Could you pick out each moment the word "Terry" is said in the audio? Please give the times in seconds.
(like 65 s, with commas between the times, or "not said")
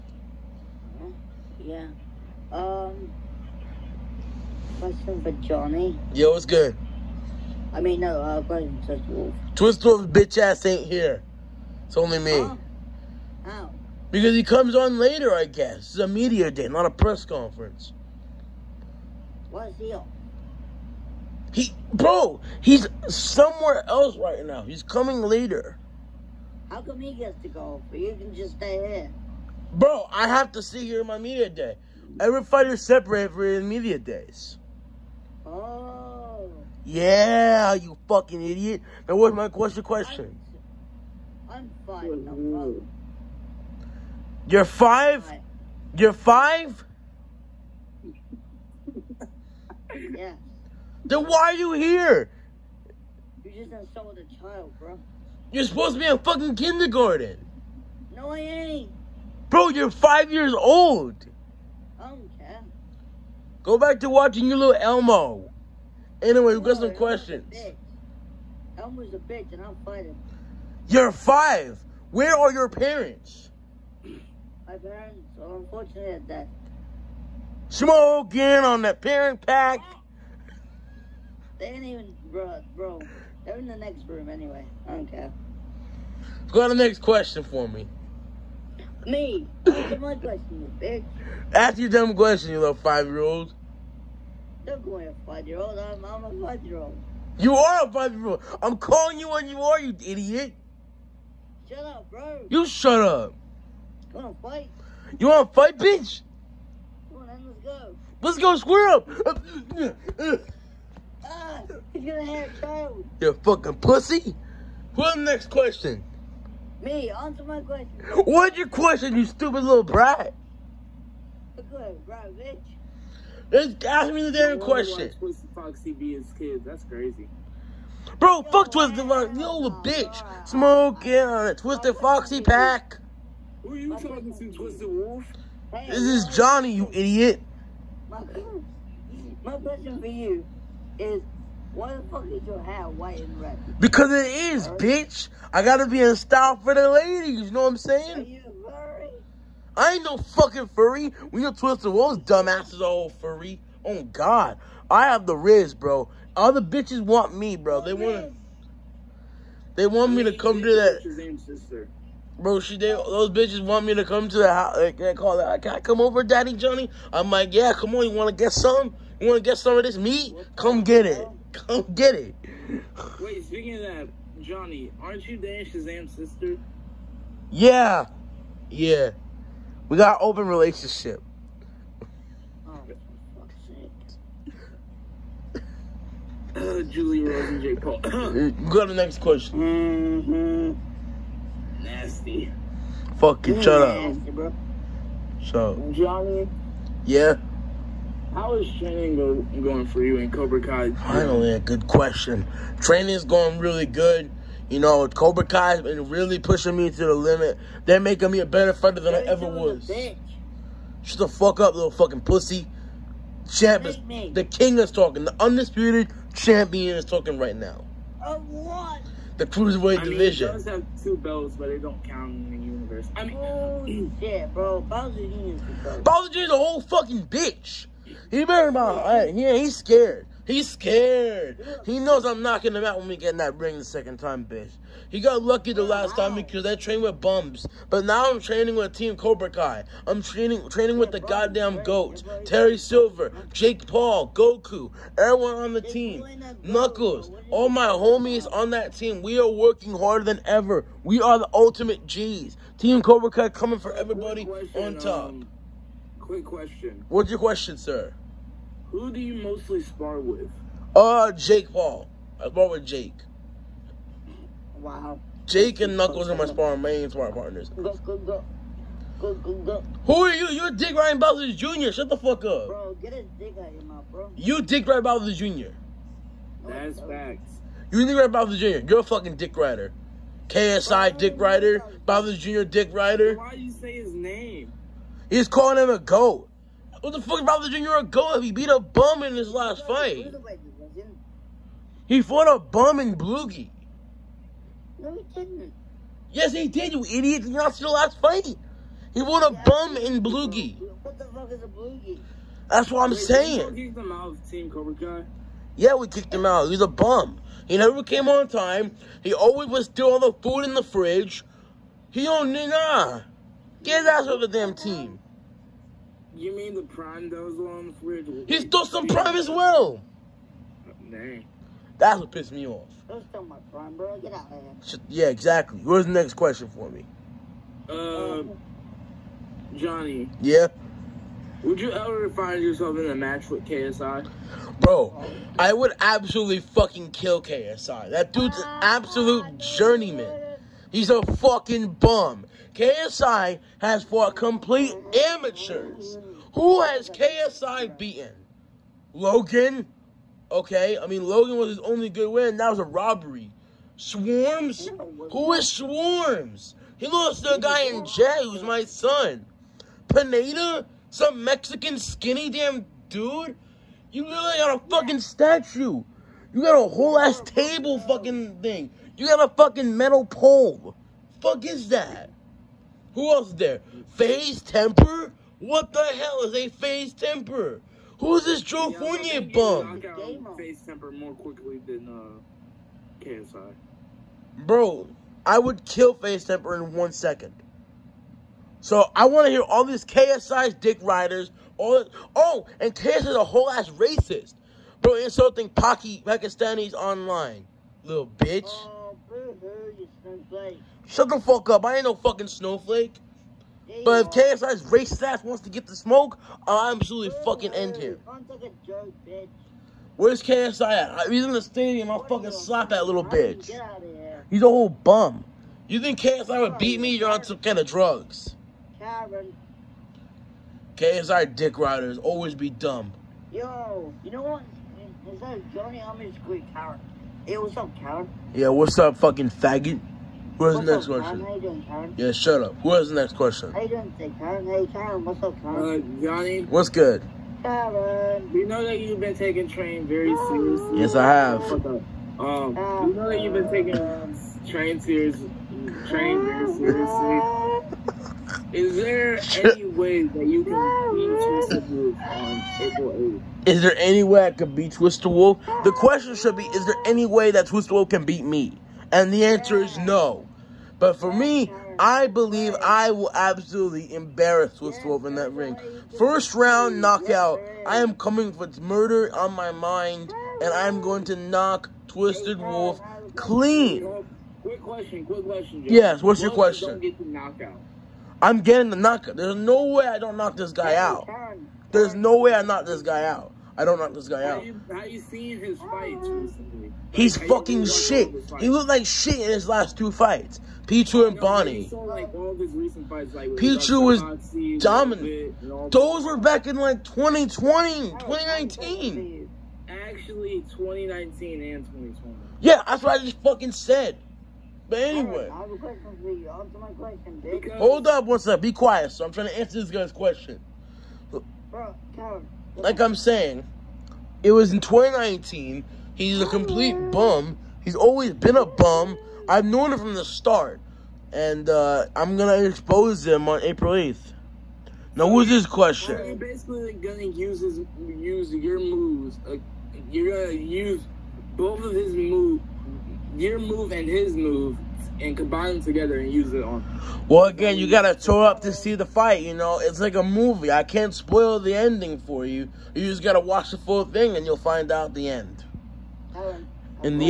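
242 s.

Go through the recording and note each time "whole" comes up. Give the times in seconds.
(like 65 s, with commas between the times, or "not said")
226 s, 366 s, 393 s, 414 s.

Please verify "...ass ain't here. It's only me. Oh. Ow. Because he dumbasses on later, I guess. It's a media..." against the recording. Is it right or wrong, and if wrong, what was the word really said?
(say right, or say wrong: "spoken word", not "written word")
wrong: "comes", not "dumbasses".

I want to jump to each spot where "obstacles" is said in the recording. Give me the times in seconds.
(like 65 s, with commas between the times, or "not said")
not said.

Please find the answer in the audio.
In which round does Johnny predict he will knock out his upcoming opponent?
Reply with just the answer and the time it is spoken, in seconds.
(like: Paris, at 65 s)
First round, at 466 s.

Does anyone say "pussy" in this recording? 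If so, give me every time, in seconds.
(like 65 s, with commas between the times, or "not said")
113 s, 212 s.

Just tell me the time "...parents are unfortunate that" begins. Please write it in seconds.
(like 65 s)
74 s.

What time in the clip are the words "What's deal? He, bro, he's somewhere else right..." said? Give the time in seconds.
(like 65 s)
19 s.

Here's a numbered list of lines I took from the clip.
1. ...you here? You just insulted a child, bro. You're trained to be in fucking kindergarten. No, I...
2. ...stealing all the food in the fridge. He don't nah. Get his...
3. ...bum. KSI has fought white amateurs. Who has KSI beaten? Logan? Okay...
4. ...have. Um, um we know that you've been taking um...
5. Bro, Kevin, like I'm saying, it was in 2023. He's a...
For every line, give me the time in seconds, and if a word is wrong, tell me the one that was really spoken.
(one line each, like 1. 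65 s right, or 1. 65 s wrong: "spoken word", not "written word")
1. 51 s wrong: "supposed", not "trained"
2. 309 s right
3. 341 s wrong: "complete", not "white"
4. 441 s right
5. 511 s wrong: "2019", not "2023".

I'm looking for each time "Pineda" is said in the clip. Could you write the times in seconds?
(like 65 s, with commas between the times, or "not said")
360 s.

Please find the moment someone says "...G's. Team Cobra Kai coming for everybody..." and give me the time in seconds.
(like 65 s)
252 s.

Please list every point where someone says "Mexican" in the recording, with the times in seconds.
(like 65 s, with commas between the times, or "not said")
361 s.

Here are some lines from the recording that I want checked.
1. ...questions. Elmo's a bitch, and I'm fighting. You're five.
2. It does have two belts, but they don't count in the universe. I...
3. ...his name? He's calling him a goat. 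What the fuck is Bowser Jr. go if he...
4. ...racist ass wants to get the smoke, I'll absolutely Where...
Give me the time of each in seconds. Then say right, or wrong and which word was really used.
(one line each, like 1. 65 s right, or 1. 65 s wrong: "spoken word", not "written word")
1. 66 s right
2. 220 s right
3. 283 s right
4. 404 s right.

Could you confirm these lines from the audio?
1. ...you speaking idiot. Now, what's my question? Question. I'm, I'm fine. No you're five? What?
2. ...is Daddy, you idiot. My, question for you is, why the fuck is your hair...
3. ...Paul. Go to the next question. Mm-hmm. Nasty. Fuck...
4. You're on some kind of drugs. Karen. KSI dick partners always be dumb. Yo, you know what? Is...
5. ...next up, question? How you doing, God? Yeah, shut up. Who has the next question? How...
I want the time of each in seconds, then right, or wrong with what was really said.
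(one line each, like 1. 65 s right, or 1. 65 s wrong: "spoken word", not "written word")
1. 37 s wrong: "fucking", not "speaking"
2. 135 s wrong: "Johnny", not "Daddy"
3. 187 s right
4. 417 s wrong: "riders", not "partners"
5. 430 s wrong: "Karen", not "God".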